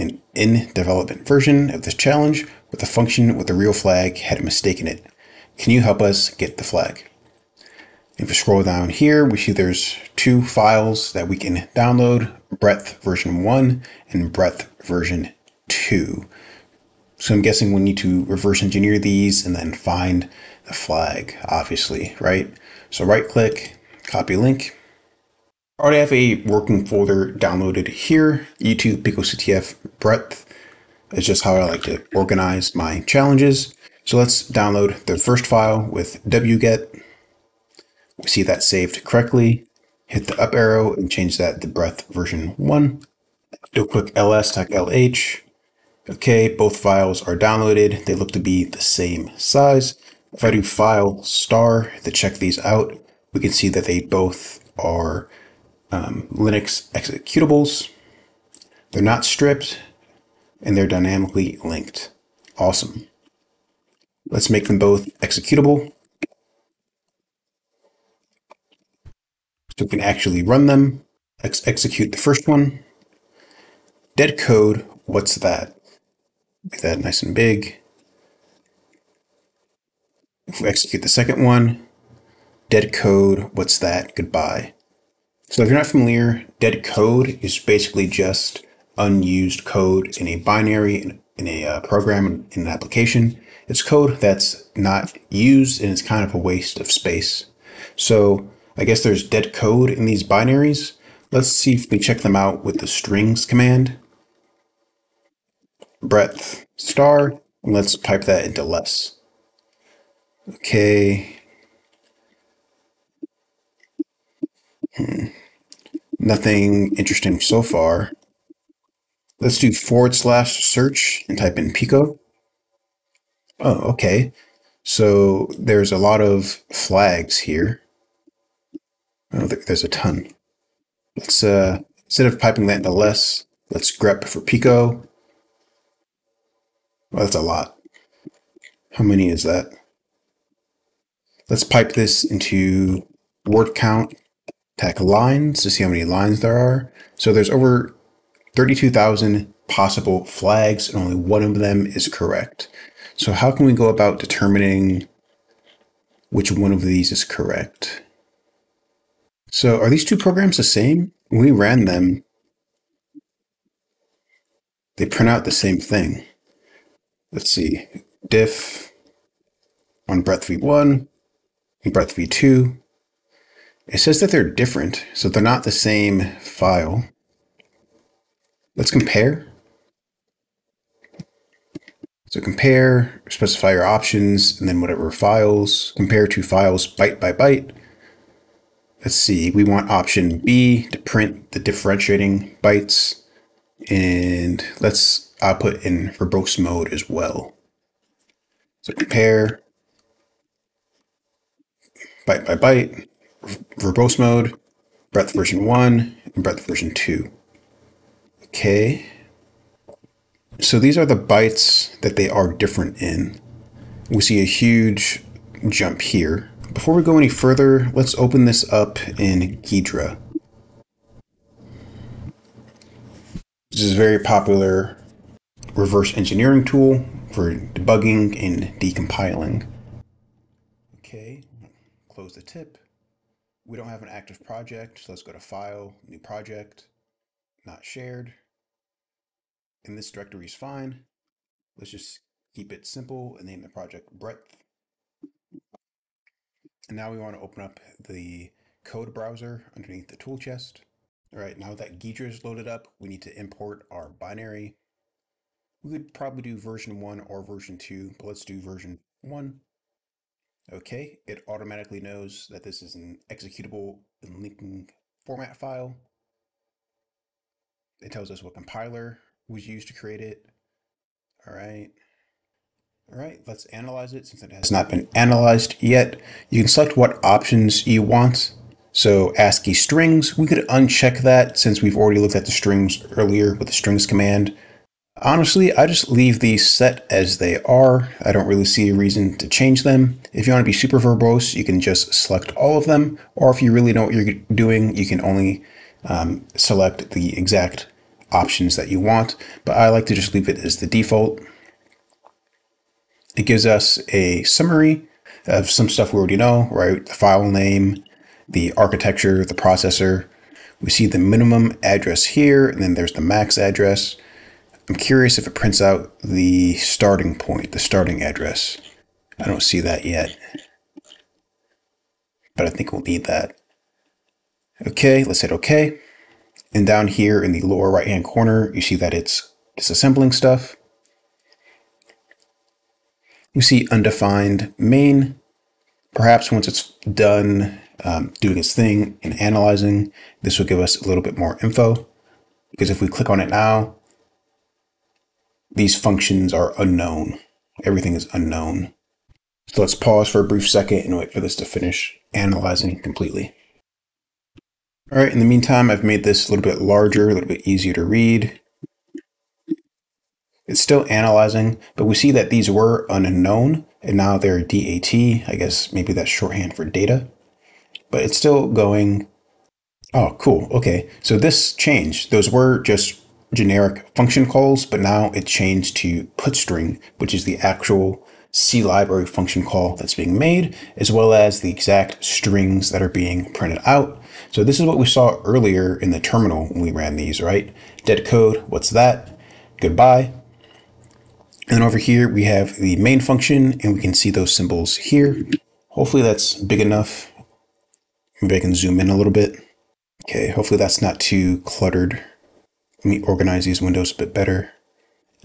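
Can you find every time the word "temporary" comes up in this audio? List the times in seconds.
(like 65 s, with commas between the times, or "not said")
not said.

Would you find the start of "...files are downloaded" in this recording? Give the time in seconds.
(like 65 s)
46 s.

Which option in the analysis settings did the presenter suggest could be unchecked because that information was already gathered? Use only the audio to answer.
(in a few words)
ASCII strings.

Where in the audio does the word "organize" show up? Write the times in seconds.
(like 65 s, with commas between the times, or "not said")
32 s, 403 s.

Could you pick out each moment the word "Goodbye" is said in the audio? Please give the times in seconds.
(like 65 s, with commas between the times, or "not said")
84 s, 389 s.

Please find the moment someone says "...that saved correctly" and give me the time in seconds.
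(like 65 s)
38 s.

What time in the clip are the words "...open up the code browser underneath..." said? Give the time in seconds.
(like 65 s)
247 s.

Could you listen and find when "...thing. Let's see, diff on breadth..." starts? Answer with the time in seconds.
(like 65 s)
165 s.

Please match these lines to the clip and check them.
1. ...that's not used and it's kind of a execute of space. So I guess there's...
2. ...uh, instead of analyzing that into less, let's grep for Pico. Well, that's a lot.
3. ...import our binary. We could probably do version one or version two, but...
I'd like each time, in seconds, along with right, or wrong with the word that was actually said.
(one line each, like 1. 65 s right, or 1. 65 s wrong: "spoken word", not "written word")
1. 94 s wrong: "waste", not "execute"
2. 131 s wrong: "piping", not "analyzing"
3. 253 s right.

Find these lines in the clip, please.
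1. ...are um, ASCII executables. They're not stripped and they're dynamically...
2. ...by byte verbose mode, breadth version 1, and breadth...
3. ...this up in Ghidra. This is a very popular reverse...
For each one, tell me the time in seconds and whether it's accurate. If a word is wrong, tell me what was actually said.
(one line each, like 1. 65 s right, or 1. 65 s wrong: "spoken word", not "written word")
1. 54 s wrong: "Linux", not "ASCII"
2. 202 s right
3. 218 s right.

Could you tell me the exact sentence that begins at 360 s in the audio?
It's still analyzing, but we see that these were unknown, and now they're DAT.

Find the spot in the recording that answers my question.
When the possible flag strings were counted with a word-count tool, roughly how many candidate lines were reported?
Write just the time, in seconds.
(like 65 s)
147 s.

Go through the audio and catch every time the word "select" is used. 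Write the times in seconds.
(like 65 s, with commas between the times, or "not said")
276 s, 292 s, 296 s.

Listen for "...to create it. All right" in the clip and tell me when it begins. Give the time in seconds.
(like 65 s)
269 s.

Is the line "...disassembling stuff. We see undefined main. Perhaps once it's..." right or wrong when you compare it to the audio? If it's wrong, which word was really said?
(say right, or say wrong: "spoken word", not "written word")
right.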